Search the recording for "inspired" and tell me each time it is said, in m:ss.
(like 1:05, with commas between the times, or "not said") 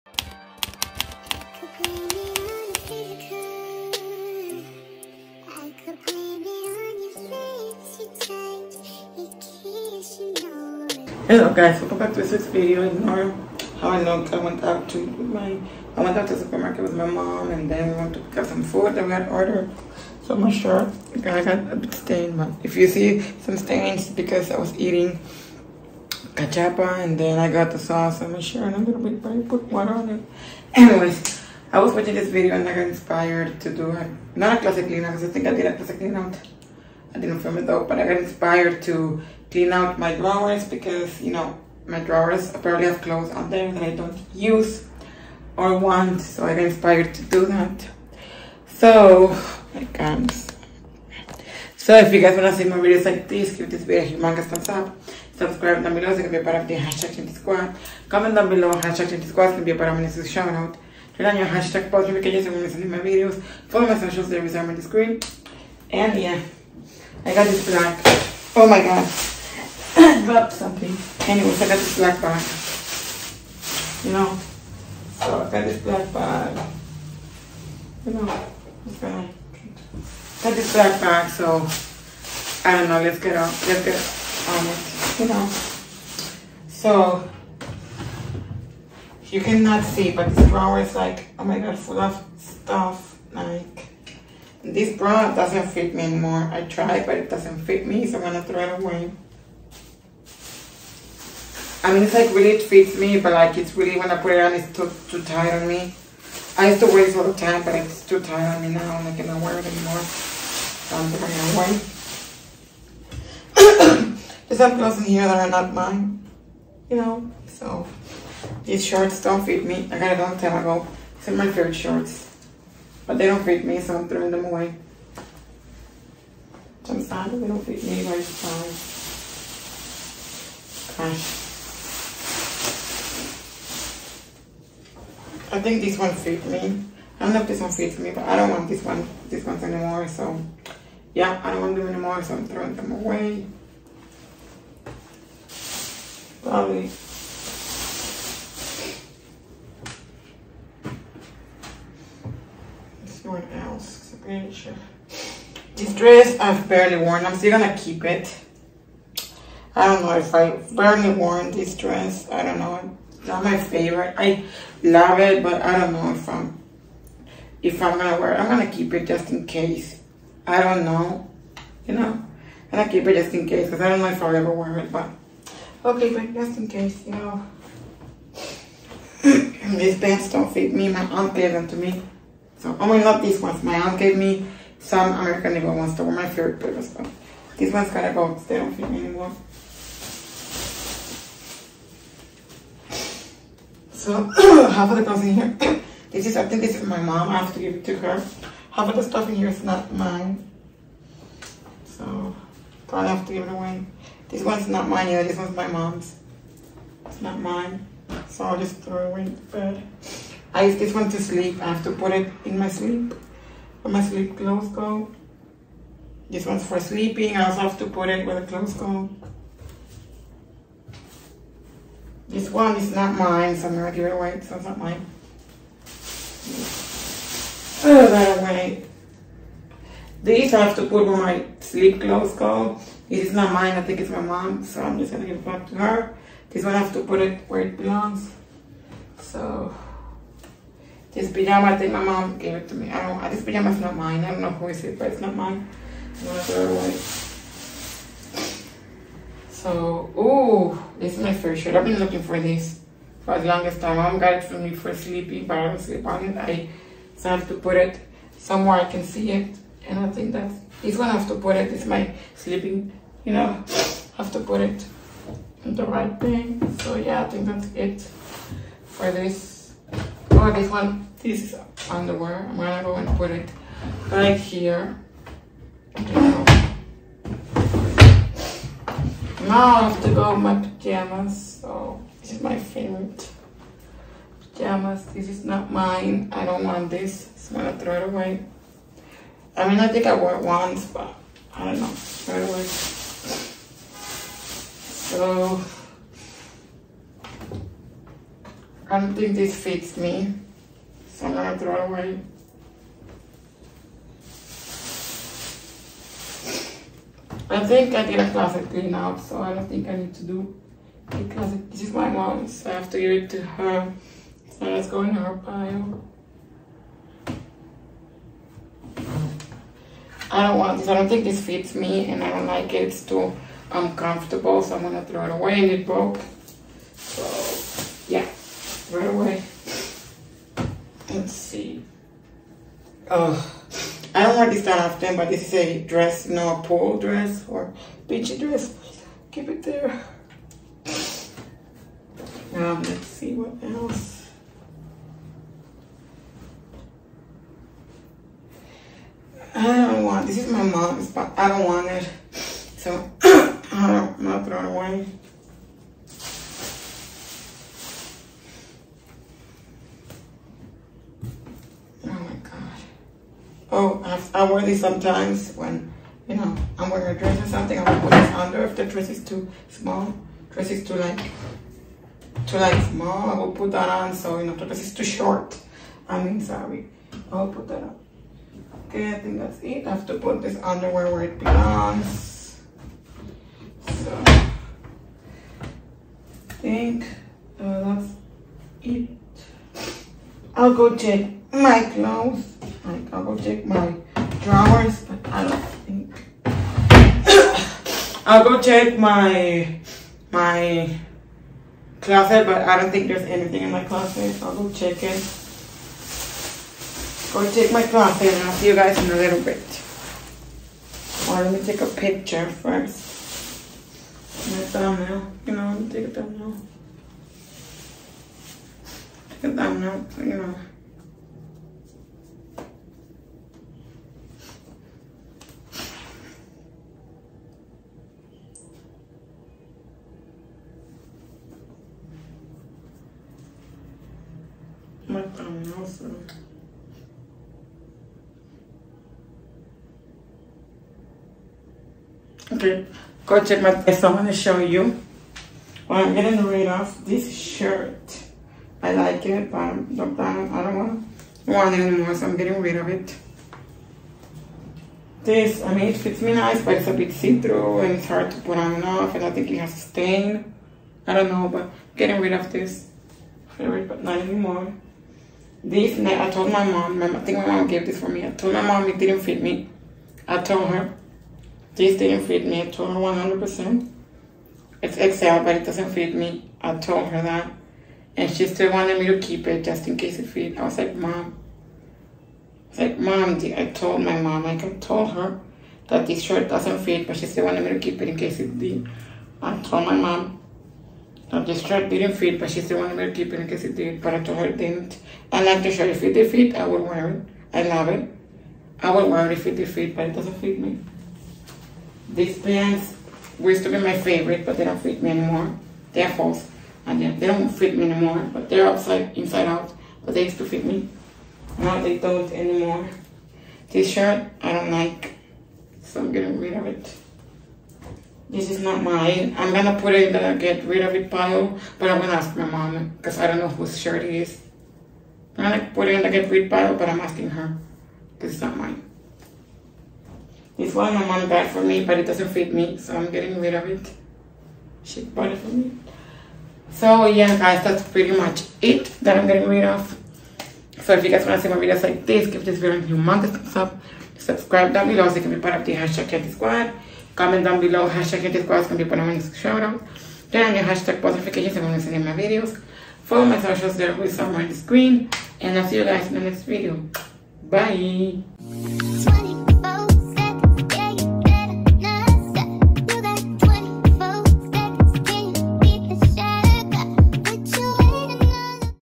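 0:32, 0:38, 0:46.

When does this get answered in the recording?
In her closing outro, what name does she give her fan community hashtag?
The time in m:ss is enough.
9:06.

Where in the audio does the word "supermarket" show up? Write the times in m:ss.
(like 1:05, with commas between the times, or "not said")
0:16.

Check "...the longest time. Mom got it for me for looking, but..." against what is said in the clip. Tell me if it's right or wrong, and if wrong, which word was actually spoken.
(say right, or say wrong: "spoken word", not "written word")
wrong: "sleeping", not "looking".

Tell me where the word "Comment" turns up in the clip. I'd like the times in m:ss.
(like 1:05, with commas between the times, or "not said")
0:58, 9:07.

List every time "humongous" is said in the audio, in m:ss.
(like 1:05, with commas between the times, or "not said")
0:54, 9:02.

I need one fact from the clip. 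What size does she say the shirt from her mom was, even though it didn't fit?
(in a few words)
XL.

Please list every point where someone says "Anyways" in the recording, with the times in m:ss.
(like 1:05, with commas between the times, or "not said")
0:30, 1:11.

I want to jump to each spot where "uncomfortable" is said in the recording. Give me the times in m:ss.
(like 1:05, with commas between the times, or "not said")
5:23.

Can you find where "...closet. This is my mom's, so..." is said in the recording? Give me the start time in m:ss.
5:11.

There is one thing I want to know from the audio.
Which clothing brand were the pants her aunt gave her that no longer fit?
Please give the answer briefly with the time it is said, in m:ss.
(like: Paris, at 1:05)
American Eagle, at 3:05.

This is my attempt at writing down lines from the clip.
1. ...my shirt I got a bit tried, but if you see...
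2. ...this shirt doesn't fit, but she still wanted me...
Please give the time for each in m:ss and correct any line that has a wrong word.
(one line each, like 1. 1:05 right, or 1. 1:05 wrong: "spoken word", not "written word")
1. 0:20 wrong: "stained", not "tried"
2. 8:06 right.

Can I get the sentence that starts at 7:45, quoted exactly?
This night, I told my mom, my, I think my mom gave this for me.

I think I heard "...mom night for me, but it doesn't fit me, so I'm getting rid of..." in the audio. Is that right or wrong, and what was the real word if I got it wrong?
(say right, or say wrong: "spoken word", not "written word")
wrong: "bought", not "night".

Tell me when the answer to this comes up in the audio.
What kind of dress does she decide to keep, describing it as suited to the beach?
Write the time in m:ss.
5:36.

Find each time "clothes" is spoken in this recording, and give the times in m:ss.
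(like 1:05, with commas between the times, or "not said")
0:43, 1:54, 3:15, 3:34, 3:38, 3:52, 6:31.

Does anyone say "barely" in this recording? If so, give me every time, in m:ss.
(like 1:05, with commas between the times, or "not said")
2:36, 2:40.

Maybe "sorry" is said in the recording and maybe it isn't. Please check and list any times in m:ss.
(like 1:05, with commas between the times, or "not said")
6:16.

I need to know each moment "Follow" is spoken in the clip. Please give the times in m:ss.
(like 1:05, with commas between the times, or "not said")
1:03, 9:13.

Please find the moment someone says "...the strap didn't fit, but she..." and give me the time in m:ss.
8:11.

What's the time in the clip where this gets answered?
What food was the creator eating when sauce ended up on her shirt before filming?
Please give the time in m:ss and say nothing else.
0:26.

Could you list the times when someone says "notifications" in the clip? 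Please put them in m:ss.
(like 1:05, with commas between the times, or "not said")
1:02, 9:11.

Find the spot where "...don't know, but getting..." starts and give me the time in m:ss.
7:41.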